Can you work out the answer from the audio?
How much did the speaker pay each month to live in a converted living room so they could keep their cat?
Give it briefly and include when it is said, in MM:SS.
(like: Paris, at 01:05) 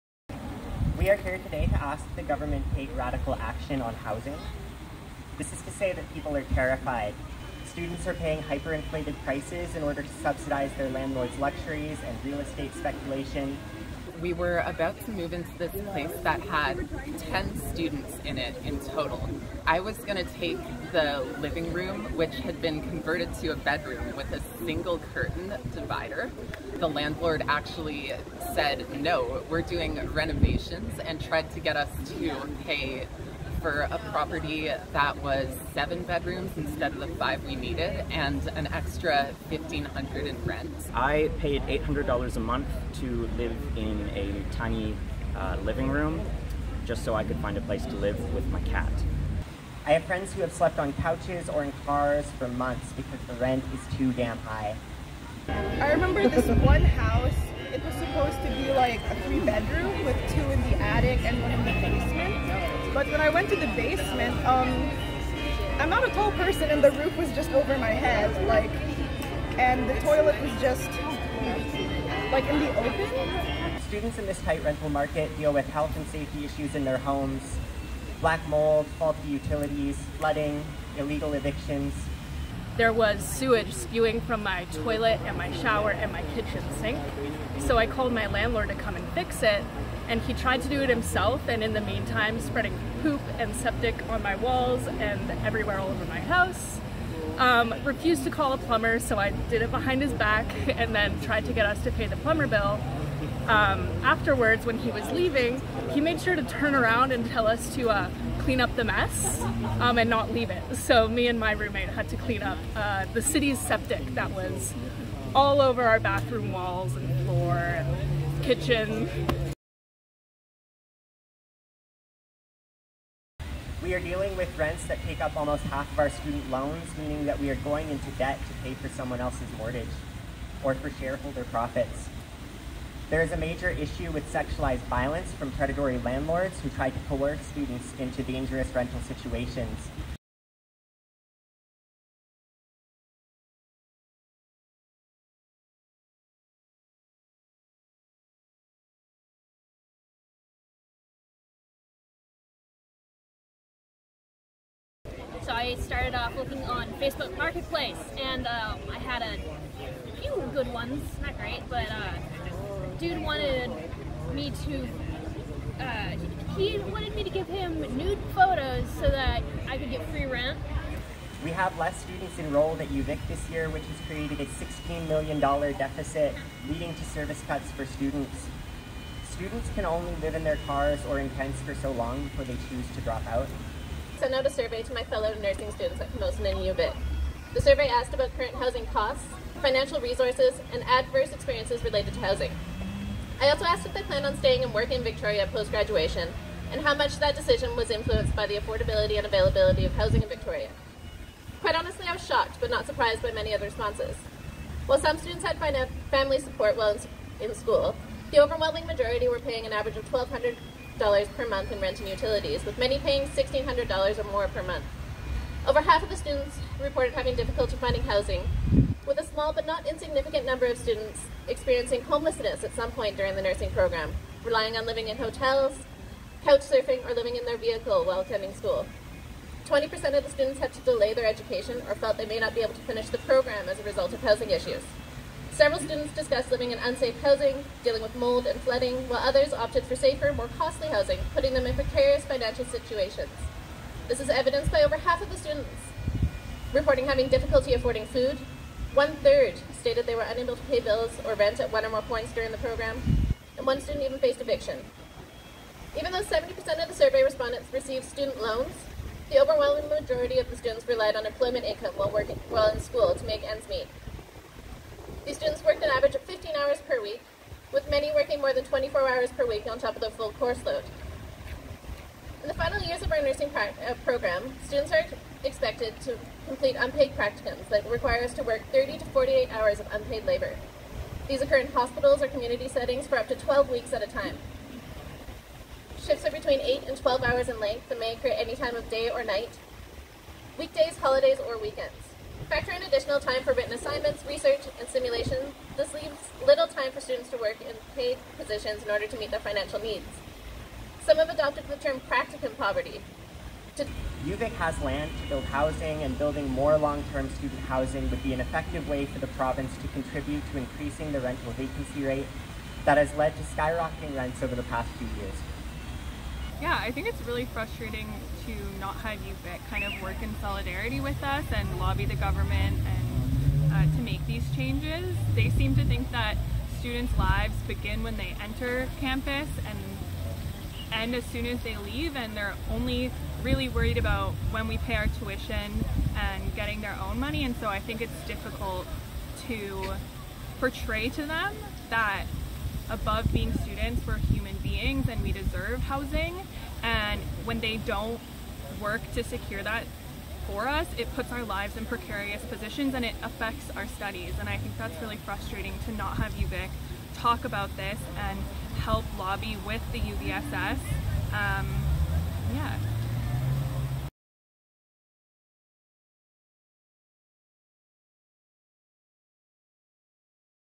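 $800, at 00:41.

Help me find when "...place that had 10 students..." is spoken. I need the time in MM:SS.
00:15.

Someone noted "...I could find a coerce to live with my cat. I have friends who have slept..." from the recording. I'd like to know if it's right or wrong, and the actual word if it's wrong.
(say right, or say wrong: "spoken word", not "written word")
wrong: "place", not "coerce".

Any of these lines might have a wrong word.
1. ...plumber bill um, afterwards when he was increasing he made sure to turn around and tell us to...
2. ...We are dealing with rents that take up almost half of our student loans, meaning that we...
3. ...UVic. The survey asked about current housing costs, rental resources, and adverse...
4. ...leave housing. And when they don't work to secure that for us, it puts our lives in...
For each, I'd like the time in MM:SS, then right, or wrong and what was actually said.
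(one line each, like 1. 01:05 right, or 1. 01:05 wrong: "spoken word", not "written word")
1. 01:42 wrong: "leaving", not "increasing"
2. 02:03 right
3. 03:06 wrong: "financial", not "rental"
4. 05:45 wrong: "deserve", not "leave".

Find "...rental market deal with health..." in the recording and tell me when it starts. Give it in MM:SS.
01:14.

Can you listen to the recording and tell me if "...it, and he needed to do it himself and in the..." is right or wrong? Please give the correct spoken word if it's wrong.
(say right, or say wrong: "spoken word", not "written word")
wrong: "tried", not "needed".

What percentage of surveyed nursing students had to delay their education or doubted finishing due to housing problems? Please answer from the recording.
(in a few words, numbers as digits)
20%.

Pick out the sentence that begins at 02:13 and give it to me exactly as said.
There is a major issue with sexualized violence from predatory landlords who try to coerce students into dangerous rental situations.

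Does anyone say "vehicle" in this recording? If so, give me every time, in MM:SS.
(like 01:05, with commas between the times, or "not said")
03:47.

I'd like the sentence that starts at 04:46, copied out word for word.
Shifts are between 8 and 12 hours in length and may occur any time of day or night, weekdays, holidays, or weekends.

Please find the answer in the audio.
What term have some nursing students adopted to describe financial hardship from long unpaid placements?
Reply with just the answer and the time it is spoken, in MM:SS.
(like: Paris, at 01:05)
practicum poverty, at 05:02.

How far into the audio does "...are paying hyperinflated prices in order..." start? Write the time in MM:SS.
00:08.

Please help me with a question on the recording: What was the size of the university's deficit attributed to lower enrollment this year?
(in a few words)
$16 million.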